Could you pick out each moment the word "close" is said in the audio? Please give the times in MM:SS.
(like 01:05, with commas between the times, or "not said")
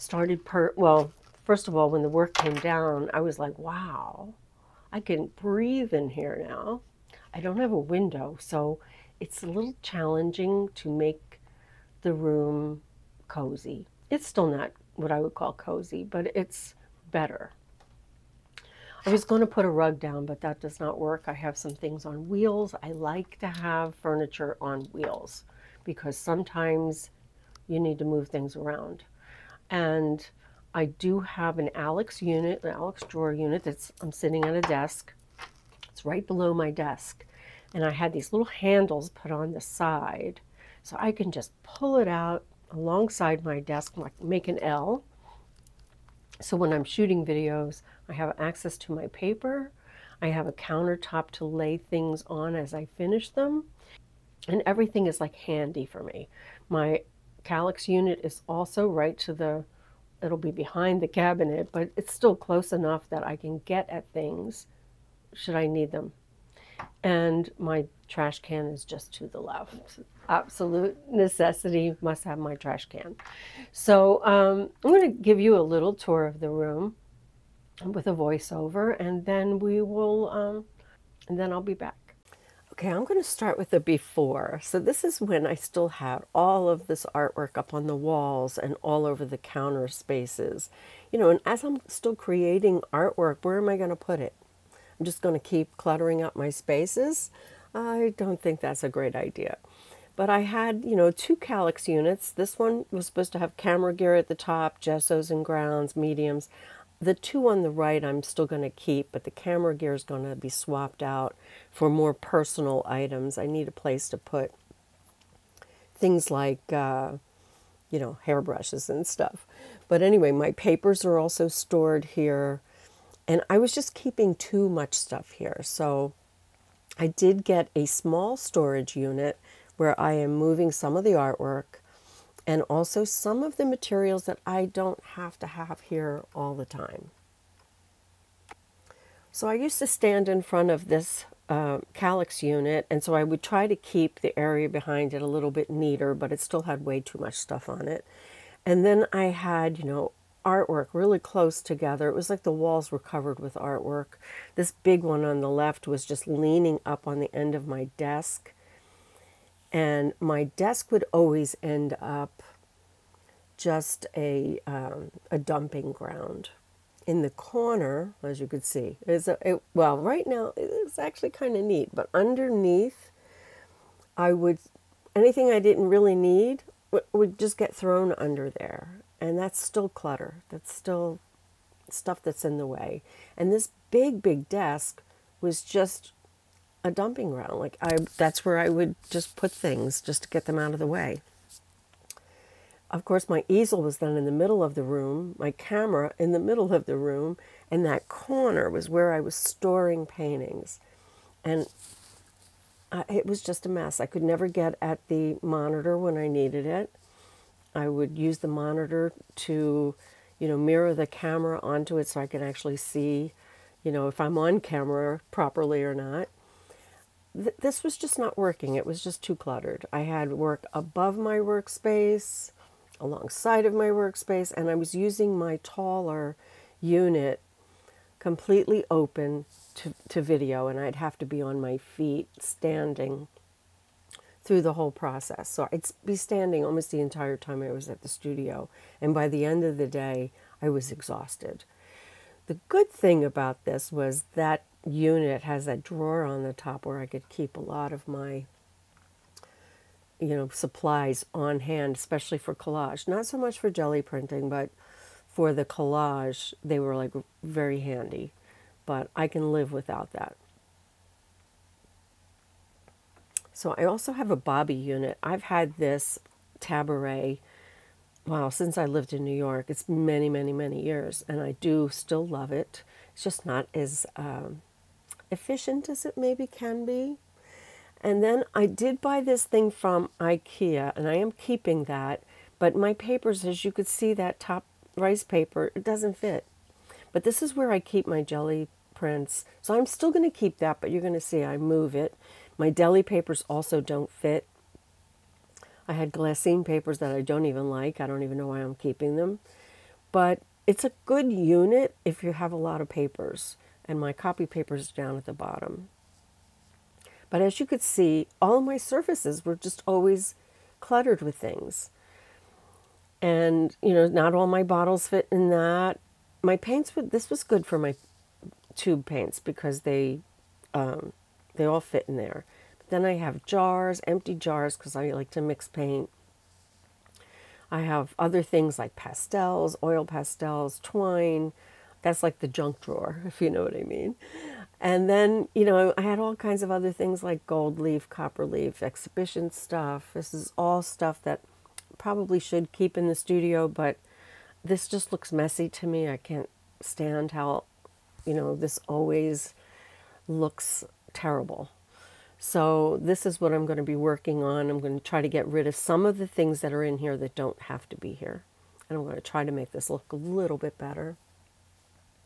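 01:02, 02:31.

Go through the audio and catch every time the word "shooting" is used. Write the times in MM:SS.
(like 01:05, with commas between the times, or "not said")
00:46.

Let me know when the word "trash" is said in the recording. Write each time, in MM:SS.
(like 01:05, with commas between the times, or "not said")
01:08, 01:12.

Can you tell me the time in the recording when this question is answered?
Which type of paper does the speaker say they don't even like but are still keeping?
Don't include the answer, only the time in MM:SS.
04:56.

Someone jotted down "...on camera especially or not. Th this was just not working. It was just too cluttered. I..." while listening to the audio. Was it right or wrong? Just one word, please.
wrong.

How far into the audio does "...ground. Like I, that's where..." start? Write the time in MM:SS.
03:07.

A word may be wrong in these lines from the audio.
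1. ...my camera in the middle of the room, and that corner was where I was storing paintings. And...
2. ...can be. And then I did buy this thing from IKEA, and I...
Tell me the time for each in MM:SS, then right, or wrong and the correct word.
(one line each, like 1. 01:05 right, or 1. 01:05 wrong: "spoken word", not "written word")
1. 03:15 right
2. 04:36 right.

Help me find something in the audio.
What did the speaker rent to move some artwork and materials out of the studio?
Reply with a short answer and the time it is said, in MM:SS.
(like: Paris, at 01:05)
a small storage unit, at 02:07.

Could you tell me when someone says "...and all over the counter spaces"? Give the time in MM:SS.
01:28.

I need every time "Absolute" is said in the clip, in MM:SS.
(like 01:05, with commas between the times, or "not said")
01:10.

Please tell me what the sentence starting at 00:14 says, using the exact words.
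It's still not what I would call cozy, but it's better.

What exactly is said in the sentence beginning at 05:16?
My paints, would, this was good for my tube paints because they um, they all fit in there.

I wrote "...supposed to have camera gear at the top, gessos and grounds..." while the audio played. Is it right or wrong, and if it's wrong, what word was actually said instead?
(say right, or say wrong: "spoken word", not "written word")
right.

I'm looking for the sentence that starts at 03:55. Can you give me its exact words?
So I'd be standing almost the entire time I was at the studio.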